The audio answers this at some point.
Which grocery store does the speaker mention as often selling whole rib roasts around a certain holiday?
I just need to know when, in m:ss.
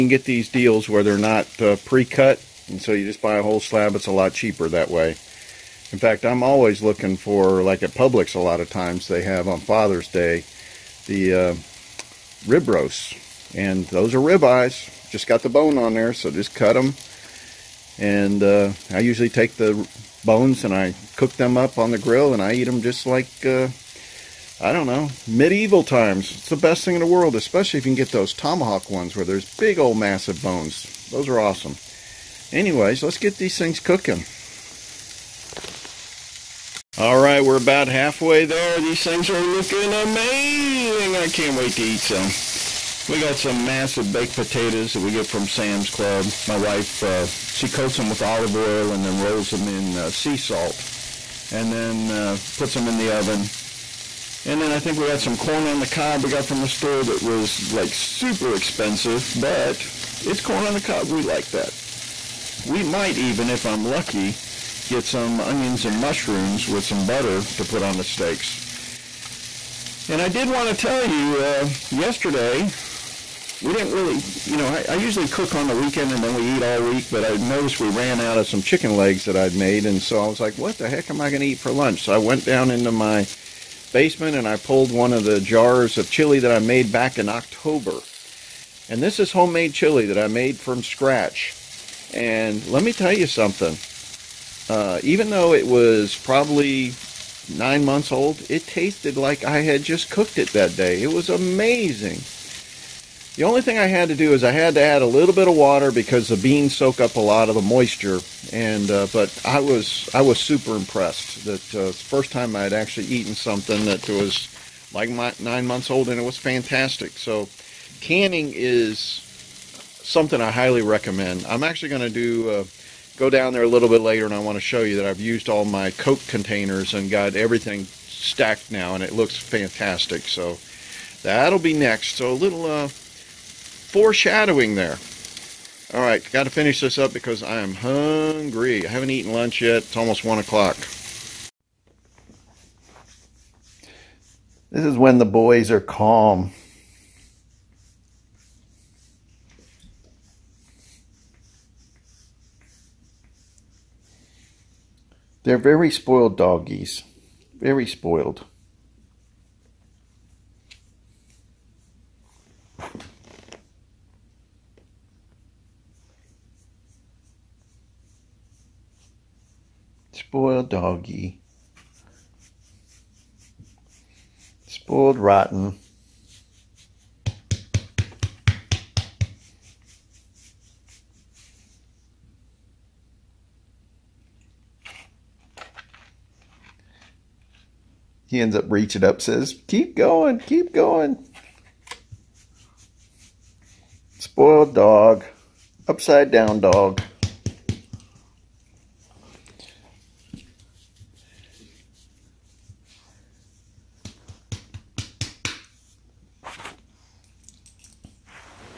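0:07.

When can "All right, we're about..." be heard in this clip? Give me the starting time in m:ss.
0:36.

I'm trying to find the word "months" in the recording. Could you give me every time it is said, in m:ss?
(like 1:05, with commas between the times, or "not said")
1:37, 1:55.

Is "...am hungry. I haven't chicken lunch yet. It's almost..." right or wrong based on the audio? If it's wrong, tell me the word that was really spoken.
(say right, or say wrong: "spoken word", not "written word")
wrong: "eaten", not "chicken".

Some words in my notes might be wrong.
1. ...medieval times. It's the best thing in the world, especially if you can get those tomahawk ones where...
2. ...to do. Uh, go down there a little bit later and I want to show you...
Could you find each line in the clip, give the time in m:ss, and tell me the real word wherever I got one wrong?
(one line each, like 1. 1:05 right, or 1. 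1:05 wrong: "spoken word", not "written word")
1. 0:25 right
2. 2:02 right.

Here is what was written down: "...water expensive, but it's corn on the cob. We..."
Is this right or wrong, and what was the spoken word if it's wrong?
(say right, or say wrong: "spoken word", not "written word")
wrong: "super", not "water".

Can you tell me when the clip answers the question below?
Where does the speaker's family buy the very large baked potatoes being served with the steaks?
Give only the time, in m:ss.
0:45.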